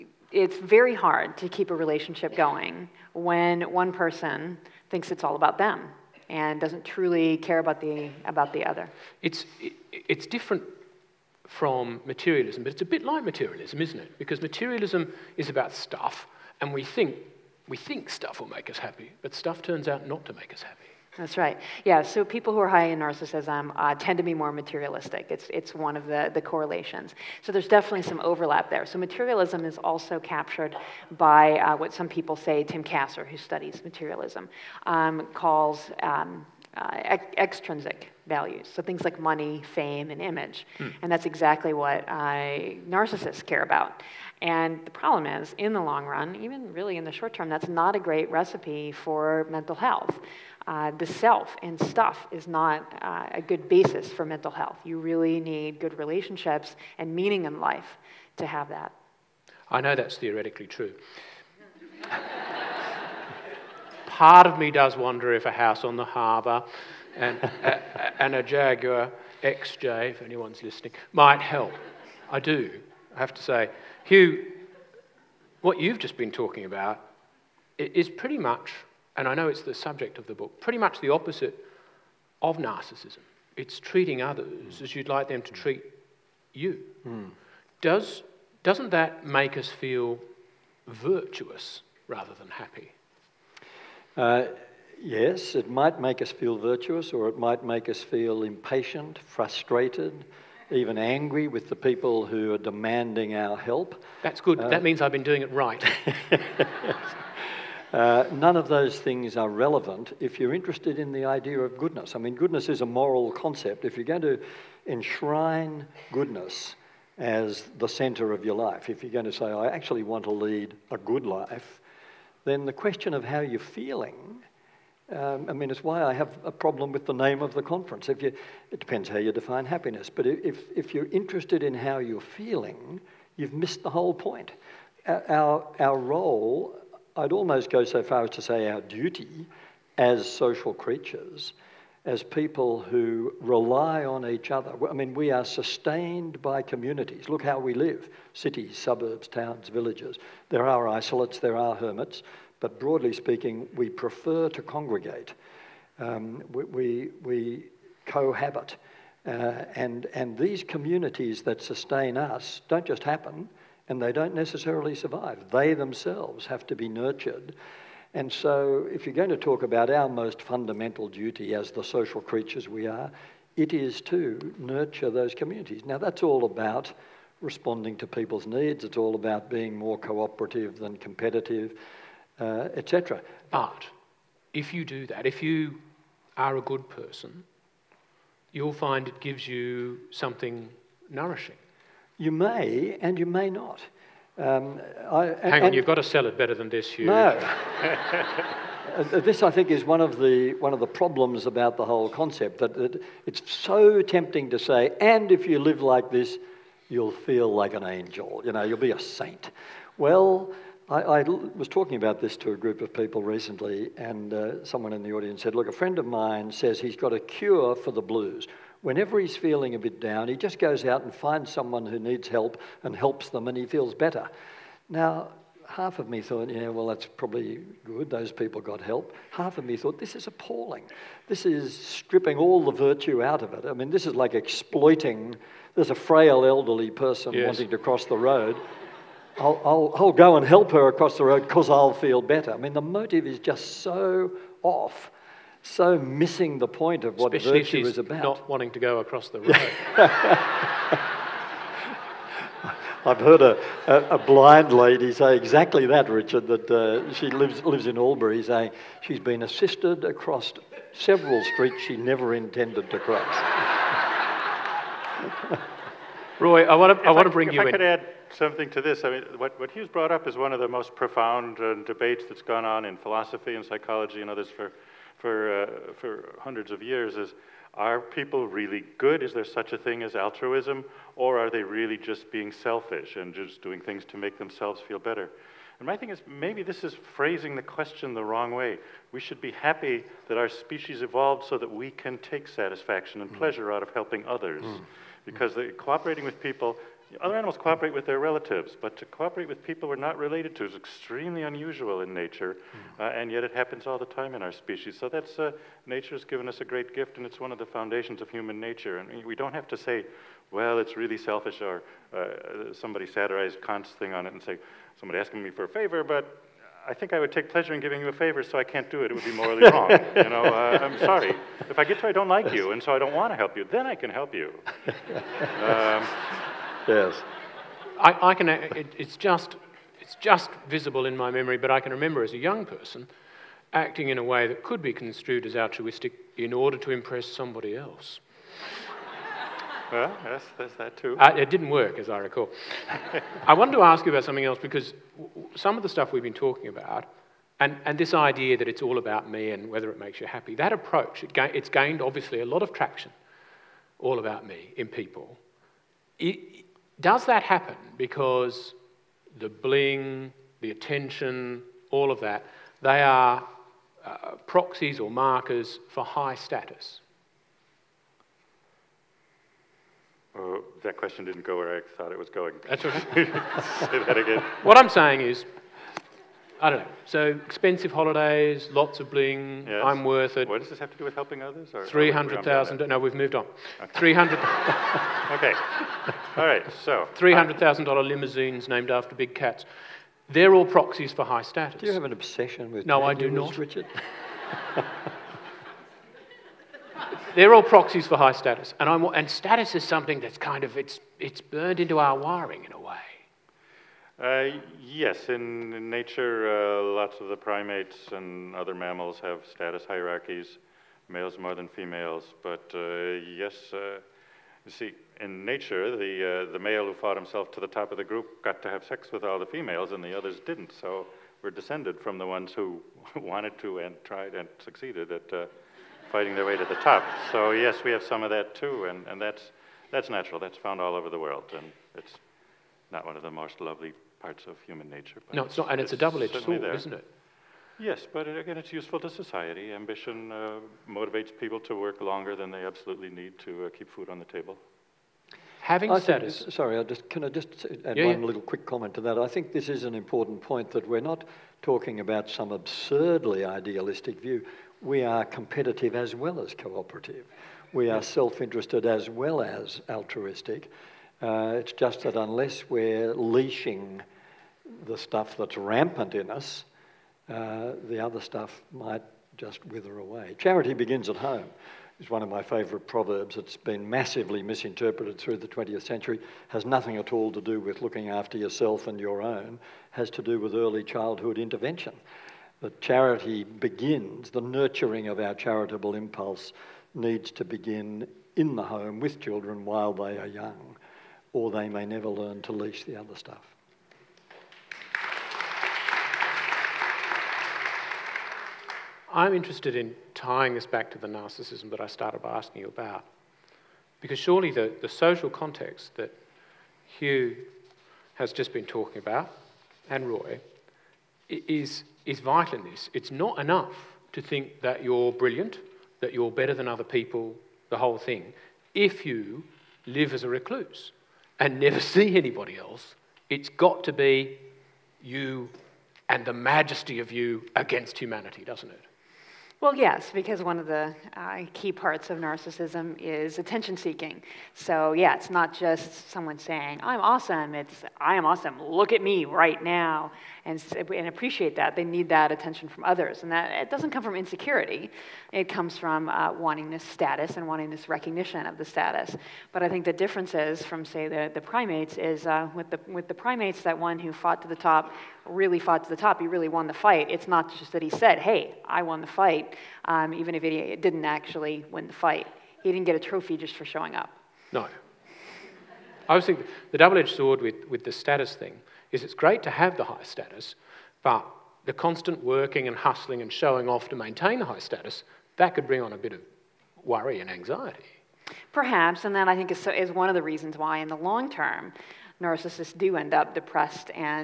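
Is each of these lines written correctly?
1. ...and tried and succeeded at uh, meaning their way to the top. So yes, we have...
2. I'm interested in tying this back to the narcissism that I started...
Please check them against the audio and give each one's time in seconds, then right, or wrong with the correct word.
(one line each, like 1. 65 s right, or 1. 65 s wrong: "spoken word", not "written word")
1. 423 s wrong: "fighting", not "meaning"
2. 499 s right.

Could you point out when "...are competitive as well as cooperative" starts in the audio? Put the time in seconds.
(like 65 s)
455 s.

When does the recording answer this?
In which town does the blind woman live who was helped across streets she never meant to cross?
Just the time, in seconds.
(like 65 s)
257 s.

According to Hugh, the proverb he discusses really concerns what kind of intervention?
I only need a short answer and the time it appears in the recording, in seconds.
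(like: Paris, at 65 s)
early childhood intervention, at 480 s.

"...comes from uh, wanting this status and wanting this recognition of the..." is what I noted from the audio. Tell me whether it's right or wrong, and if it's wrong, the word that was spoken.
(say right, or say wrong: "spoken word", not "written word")
right.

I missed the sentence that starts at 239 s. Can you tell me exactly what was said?
I'll, I'll, I'll go and help her across the road because I'll feel better.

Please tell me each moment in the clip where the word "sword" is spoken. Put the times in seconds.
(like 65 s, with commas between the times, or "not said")
436 s, 567 s.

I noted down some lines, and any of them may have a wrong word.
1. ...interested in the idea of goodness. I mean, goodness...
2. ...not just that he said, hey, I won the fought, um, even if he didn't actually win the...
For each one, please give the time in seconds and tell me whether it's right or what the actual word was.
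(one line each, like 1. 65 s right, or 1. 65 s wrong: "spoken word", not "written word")
1. 110 s right
2. 557 s wrong: "fight", not "fought".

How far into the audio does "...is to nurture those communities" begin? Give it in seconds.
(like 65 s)
173 s.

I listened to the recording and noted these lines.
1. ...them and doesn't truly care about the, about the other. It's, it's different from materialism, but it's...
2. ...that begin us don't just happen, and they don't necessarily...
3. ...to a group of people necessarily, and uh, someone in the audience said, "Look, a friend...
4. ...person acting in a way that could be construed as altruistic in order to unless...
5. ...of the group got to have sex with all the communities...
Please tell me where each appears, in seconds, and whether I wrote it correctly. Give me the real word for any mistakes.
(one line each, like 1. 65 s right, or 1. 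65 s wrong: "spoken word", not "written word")
1. 5 s right
2. 161 s wrong: "sustain", not "begin"
3. 212 s wrong: "recently", not "necessarily"
4. 332 s wrong: "impress", not "unless"
5. 417 s wrong: "females", not "communities".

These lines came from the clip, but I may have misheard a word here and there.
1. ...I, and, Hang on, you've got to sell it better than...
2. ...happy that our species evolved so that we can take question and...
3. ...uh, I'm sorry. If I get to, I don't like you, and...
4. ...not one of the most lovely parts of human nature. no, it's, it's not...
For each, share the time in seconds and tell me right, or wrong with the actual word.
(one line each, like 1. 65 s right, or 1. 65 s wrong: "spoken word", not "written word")
1. 195 s right
2. 289 s wrong: "satisfaction", not "question"
3. 320 s right
4. 432 s right.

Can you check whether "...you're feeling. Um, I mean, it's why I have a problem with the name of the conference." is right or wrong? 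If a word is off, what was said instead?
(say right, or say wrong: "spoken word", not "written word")
right.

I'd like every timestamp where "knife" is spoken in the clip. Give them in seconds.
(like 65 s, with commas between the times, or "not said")
not said.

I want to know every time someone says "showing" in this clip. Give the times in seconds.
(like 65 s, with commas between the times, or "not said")
563 s, 573 s.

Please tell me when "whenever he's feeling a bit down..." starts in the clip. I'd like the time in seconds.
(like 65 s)
218 s.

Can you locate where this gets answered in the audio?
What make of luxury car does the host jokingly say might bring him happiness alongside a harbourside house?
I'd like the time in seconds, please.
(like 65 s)
68 s.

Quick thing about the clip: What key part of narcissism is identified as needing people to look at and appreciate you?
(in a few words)
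attention seeking.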